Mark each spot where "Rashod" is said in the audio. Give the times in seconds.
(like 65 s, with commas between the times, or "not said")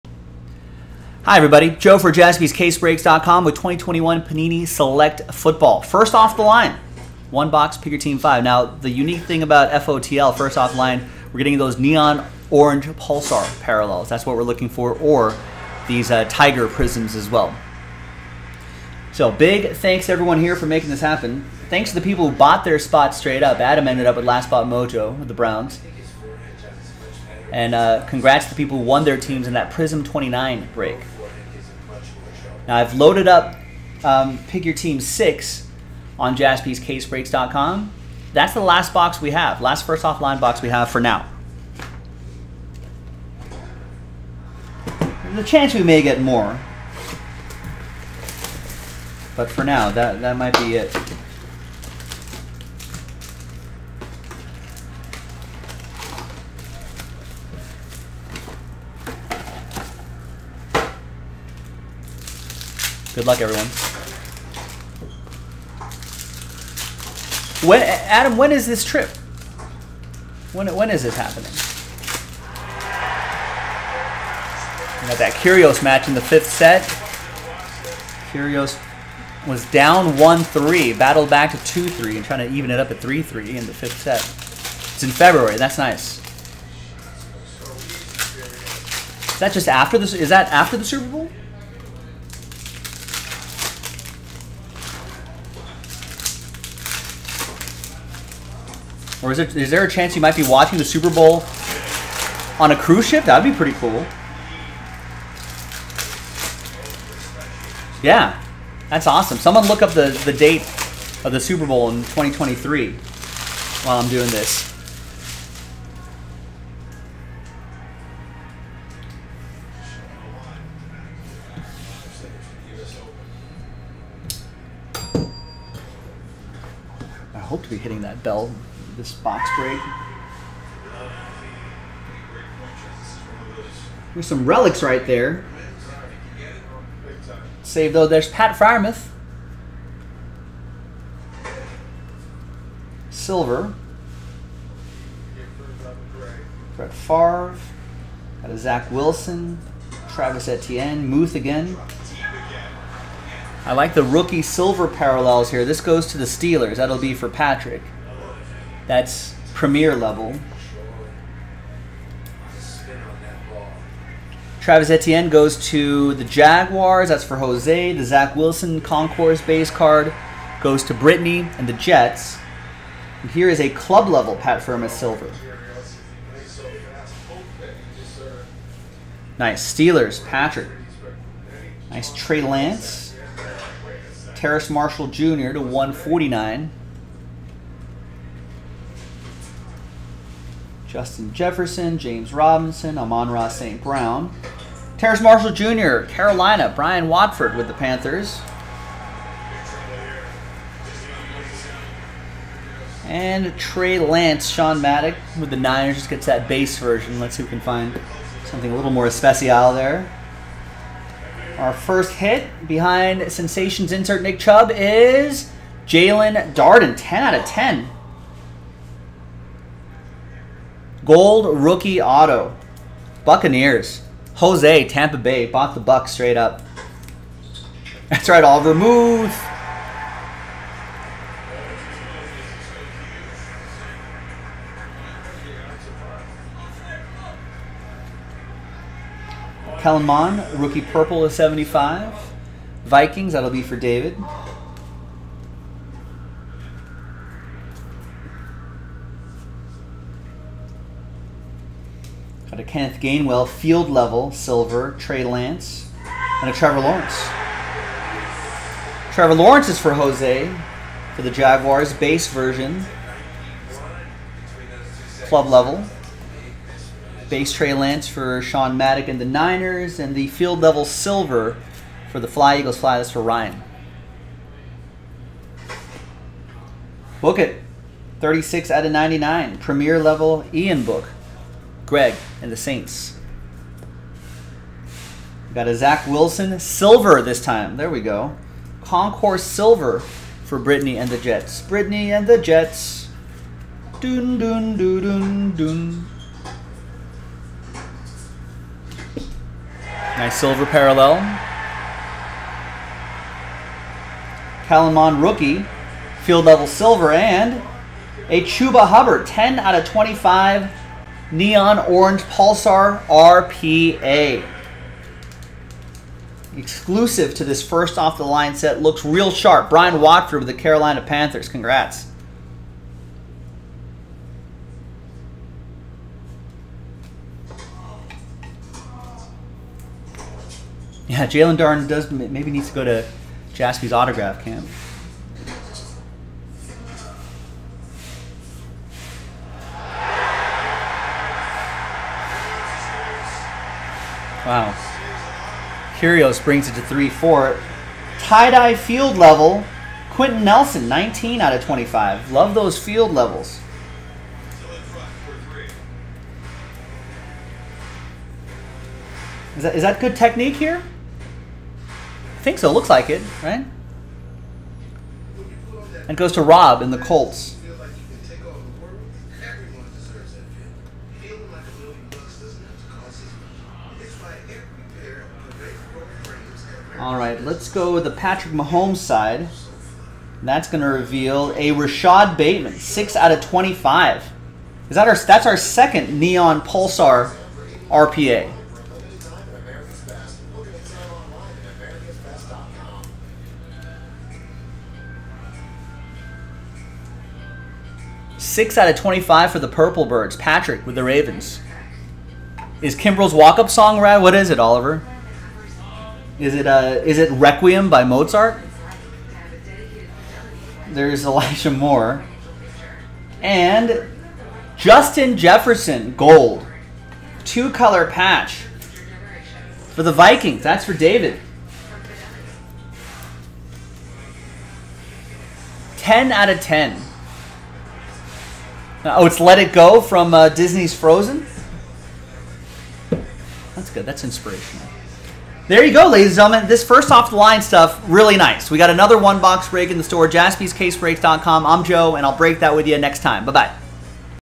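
381 s.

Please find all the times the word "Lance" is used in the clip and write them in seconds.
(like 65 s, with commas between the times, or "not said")
182 s, 203 s, 255 s, 267 s.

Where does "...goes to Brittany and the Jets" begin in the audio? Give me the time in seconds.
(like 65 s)
170 s.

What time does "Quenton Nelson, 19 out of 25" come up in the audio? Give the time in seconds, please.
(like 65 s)
350 s.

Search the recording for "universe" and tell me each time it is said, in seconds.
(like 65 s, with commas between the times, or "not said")
not said.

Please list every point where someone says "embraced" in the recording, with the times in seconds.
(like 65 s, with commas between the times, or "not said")
not said.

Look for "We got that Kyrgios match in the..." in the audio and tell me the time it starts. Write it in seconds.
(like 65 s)
75 s.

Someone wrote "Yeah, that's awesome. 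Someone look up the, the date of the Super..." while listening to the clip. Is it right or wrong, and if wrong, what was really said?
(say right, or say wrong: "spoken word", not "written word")
right.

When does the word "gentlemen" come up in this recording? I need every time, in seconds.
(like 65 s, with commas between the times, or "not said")
436 s.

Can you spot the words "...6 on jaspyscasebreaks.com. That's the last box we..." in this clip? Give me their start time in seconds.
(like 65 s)
35 s.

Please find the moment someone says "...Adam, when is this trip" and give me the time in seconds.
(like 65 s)
67 s.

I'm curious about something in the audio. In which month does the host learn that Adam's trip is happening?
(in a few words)
February.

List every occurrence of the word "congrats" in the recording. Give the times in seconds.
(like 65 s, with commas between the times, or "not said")
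28 s, 321 s.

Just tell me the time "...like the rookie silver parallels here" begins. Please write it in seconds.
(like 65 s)
153 s.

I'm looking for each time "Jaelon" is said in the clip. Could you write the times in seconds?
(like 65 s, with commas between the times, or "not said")
215 s, 331 s.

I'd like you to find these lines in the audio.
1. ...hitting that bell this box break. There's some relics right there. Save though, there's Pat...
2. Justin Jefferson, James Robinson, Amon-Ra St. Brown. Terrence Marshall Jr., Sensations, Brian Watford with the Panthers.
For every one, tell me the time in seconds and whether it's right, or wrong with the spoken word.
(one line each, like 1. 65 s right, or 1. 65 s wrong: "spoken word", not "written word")
1. 127 s right
2. 190 s wrong: "Carolina", not "Sensations".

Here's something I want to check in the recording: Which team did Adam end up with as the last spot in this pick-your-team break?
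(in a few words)
Browns.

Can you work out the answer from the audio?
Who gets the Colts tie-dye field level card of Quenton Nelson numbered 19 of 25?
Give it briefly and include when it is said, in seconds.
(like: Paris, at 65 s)
Rob, at 366 s.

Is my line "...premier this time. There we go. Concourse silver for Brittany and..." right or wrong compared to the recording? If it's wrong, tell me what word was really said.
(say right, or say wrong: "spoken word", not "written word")
wrong: "silver", not "premier".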